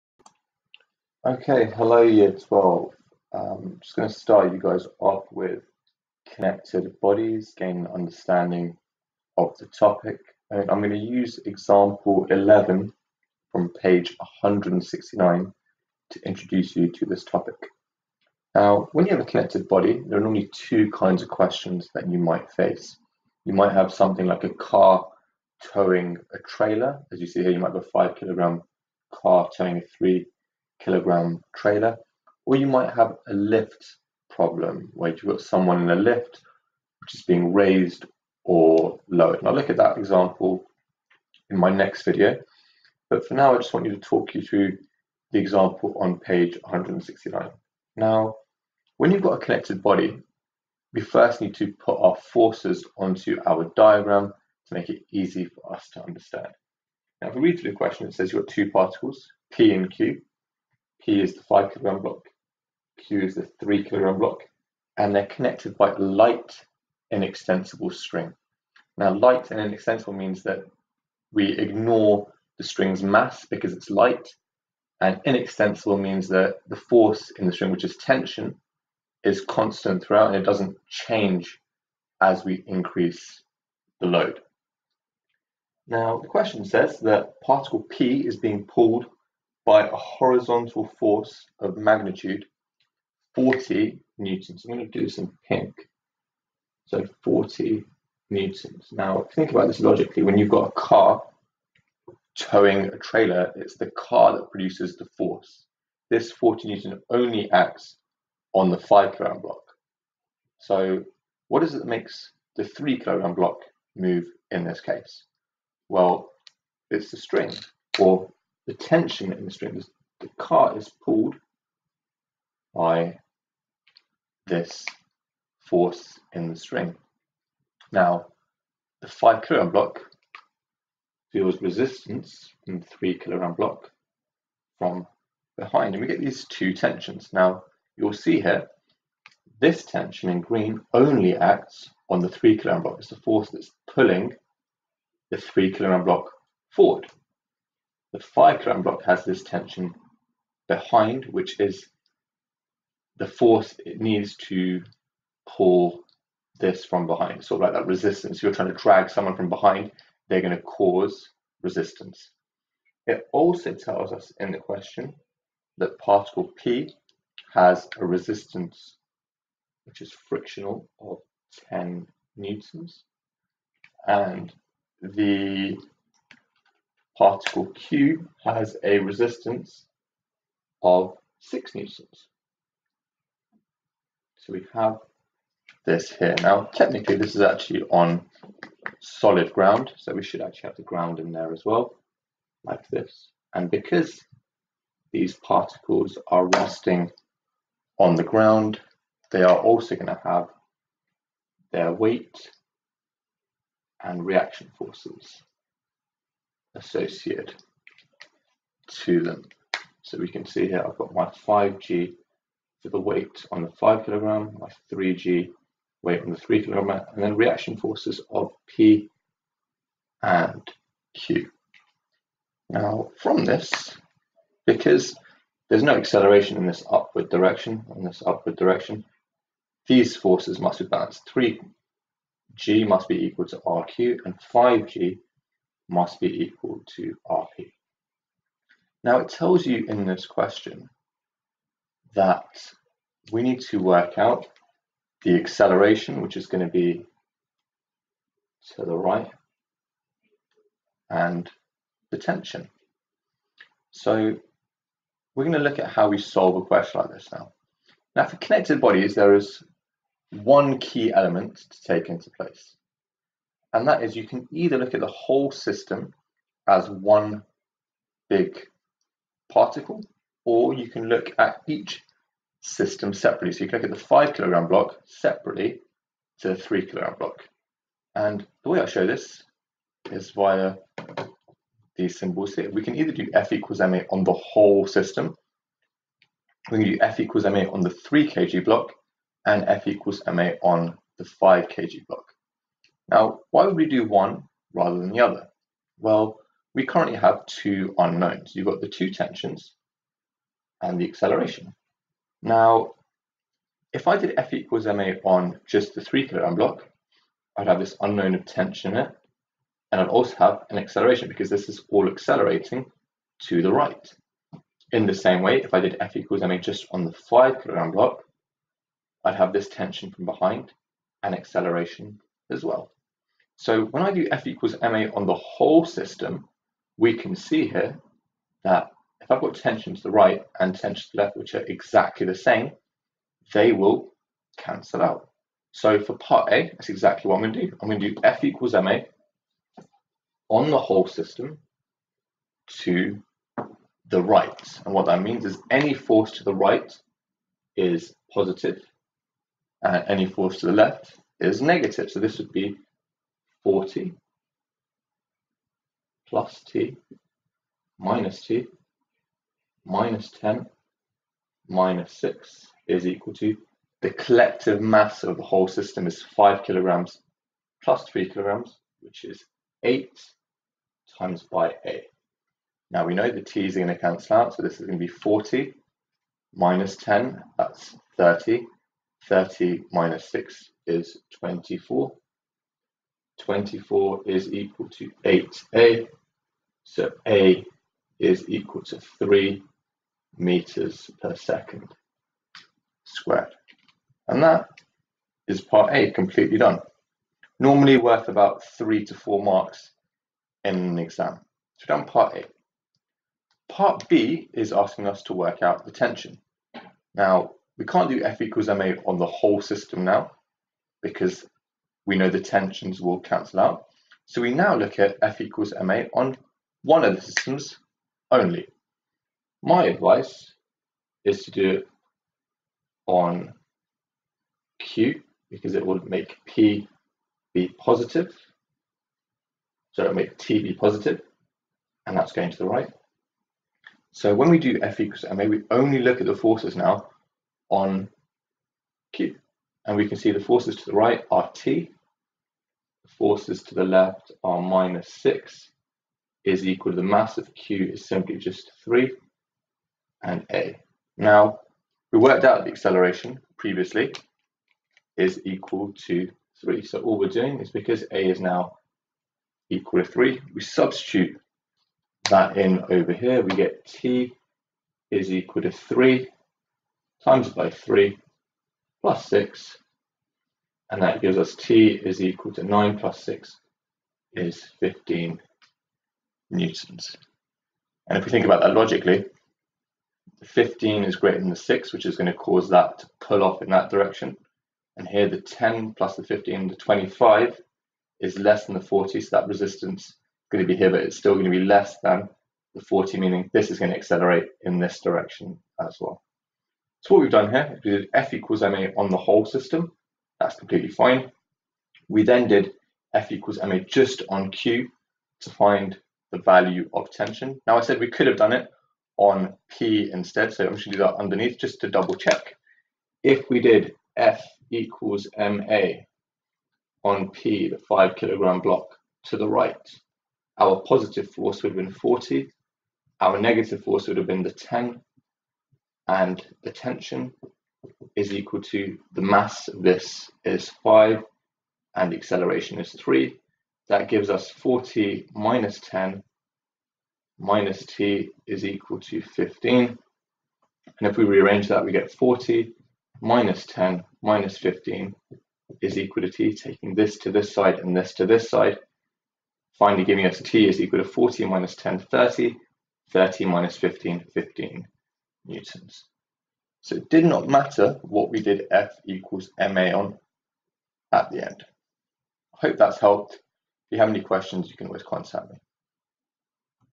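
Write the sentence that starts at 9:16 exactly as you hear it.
So it did not matter what we did F equals MA on at the end.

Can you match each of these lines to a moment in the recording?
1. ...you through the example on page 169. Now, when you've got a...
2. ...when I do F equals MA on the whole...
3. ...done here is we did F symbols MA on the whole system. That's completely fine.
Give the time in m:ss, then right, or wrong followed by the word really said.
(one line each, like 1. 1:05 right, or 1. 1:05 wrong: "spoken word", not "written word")
1. 0:44 right
2. 5:23 right
3. 8:17 wrong: "equals", not "symbols".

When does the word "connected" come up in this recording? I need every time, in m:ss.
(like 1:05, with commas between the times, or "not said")
0:06, 0:19, 0:49, 1:05, 4:18.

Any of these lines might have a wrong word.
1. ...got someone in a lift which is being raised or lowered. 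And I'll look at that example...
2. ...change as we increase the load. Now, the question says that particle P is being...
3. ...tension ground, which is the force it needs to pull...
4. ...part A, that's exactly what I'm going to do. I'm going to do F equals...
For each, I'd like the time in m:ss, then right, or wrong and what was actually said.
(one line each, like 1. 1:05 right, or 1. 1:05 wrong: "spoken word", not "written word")
1. 0:35 right
2. 1:20 right
3. 2:29 wrong: "behind", not "ground"
4. 5:36 right.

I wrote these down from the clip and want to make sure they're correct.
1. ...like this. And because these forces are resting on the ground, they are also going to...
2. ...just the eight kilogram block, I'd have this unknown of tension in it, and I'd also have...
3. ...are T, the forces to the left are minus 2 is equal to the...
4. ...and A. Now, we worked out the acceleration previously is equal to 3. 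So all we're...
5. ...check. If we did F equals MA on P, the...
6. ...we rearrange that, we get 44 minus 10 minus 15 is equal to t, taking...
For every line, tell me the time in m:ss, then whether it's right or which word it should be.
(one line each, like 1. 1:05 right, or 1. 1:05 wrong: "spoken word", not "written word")
1. 3:12 wrong: "particles", not "forces"
2. 5:05 wrong: "three", not "eight"
3. 7:21 wrong: "6", not "2"
4. 7:30 right
5. 8:32 right
6. 9:01 wrong: "40", not "44".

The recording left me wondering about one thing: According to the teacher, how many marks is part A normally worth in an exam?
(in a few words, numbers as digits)
3 to 4 marks.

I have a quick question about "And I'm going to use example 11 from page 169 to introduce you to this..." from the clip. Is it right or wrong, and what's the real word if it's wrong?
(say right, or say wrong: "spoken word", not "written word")
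right.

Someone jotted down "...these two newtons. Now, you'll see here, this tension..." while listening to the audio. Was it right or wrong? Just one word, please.
wrong.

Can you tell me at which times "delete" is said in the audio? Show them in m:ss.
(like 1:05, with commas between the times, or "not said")
not said.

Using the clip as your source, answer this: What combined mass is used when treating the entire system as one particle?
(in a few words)
8.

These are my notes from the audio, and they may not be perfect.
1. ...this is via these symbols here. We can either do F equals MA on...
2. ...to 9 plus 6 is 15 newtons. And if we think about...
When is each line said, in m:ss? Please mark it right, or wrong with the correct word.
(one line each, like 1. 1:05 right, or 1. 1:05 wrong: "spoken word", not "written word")
1. 4:39 right
2. 7:52 right.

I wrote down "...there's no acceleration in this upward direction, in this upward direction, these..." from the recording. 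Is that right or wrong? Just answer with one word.
right.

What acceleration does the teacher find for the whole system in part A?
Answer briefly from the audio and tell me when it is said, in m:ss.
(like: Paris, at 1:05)
3 m/s², at 6:29.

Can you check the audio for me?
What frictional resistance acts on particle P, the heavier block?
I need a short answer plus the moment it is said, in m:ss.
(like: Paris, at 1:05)
10 newtons, at 2:51.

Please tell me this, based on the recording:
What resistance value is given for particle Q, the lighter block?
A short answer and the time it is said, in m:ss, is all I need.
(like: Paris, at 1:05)
6 newtons, at 3:01.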